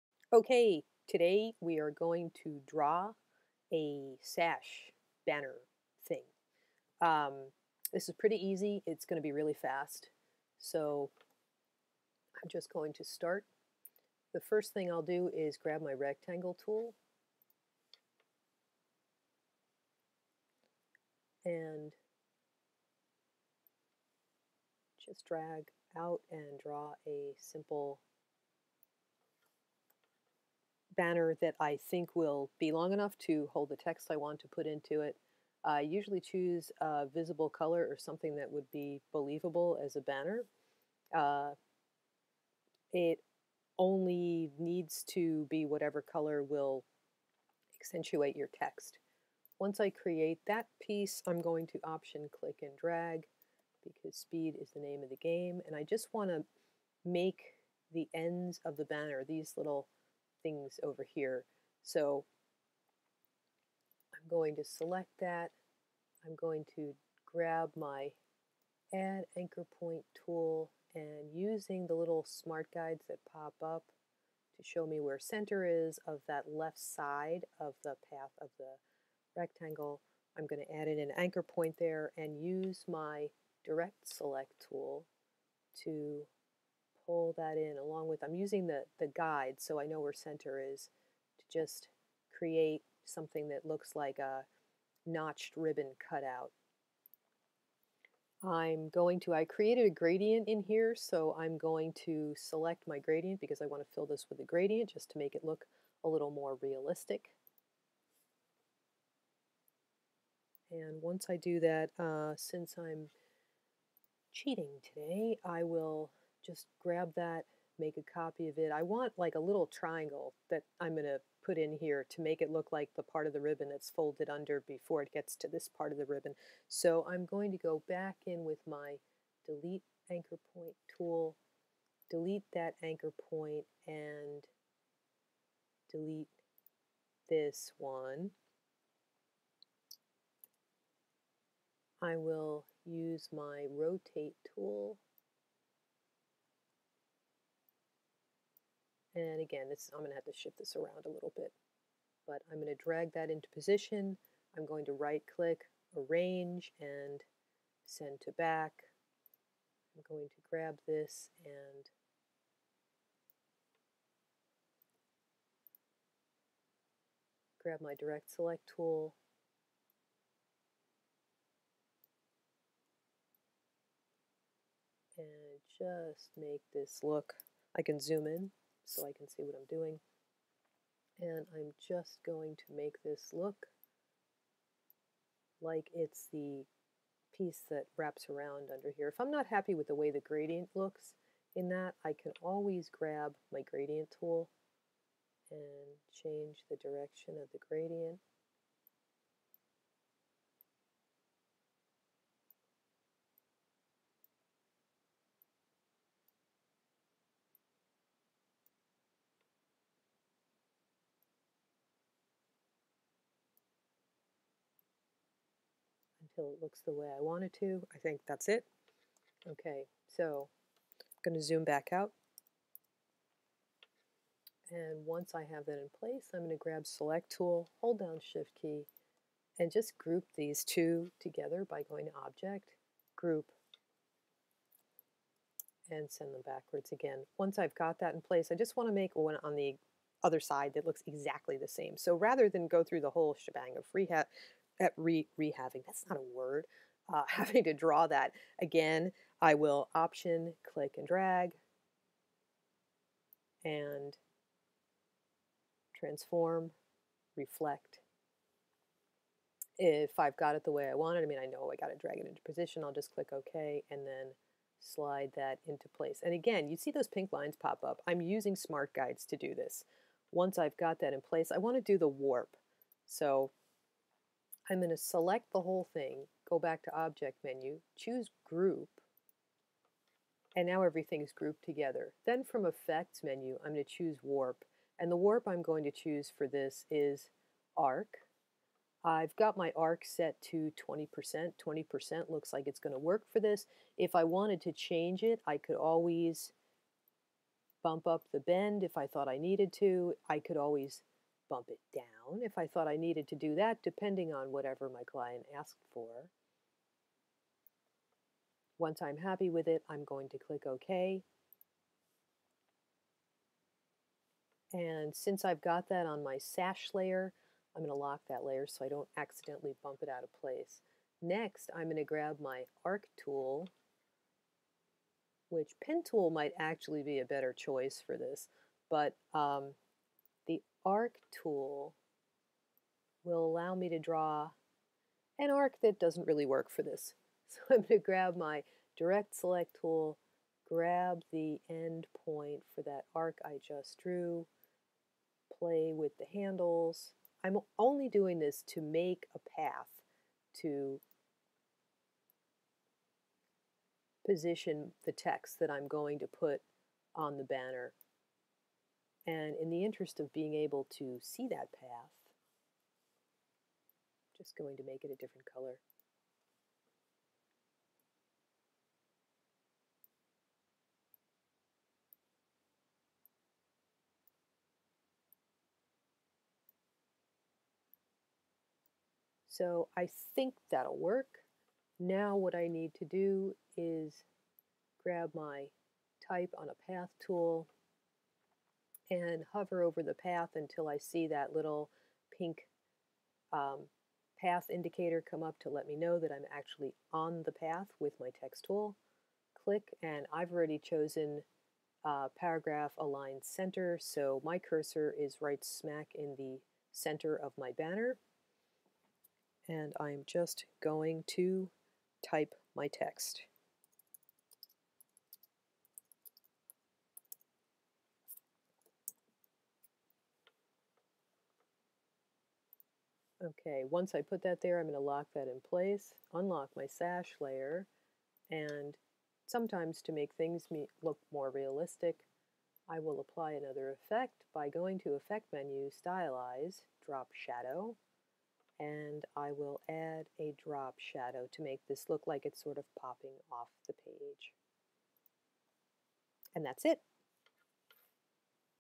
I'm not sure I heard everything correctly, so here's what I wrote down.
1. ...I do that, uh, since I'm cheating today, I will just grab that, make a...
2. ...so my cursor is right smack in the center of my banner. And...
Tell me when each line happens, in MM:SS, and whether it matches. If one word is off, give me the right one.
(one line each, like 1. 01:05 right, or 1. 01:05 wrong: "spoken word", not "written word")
1. 01:51 right
2. 06:44 right.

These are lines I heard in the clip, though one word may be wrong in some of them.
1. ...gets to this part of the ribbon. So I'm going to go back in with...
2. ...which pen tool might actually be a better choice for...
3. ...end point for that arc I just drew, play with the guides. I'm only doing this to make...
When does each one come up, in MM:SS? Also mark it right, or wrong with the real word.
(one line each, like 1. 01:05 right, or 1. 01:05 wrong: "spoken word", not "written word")
1. 02:05 right
2. 05:25 right
3. 05:41 wrong: "handles", not "guides".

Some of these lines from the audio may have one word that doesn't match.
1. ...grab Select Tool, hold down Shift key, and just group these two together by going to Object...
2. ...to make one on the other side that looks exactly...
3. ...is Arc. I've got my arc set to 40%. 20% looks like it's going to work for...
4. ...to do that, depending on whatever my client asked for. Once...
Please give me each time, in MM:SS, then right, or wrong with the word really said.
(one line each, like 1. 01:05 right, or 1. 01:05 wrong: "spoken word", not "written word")
1. 03:46 right
2. 03:58 right
3. 04:46 wrong: "20", not "40"
4. 05:03 right.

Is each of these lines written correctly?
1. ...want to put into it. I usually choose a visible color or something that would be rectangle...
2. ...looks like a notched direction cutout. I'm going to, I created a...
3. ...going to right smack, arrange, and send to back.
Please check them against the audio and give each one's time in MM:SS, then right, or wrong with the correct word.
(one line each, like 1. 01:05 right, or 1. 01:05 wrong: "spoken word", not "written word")
1. 00:34 wrong: "believable", not "rectangle"
2. 01:33 wrong: "ribbon", not "direction"
3. 02:34 wrong: "click", not "smack".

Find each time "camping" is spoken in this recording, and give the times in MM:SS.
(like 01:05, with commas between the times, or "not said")
not said.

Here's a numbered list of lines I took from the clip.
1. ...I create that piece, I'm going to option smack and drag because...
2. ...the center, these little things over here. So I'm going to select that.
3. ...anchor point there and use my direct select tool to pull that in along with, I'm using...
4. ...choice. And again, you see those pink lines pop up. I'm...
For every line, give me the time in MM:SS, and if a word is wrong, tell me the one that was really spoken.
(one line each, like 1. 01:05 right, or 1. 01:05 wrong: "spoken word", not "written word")
1. 00:49 wrong: "click", not "smack"
2. 00:58 wrong: "banner", not "center"
3. 01:21 right
4. 04:25 wrong: "place", not "choice".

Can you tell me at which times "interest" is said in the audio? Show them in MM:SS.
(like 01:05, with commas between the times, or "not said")
05:59.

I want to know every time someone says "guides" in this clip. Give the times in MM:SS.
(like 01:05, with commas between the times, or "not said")
01:12, 01:29, 04:28.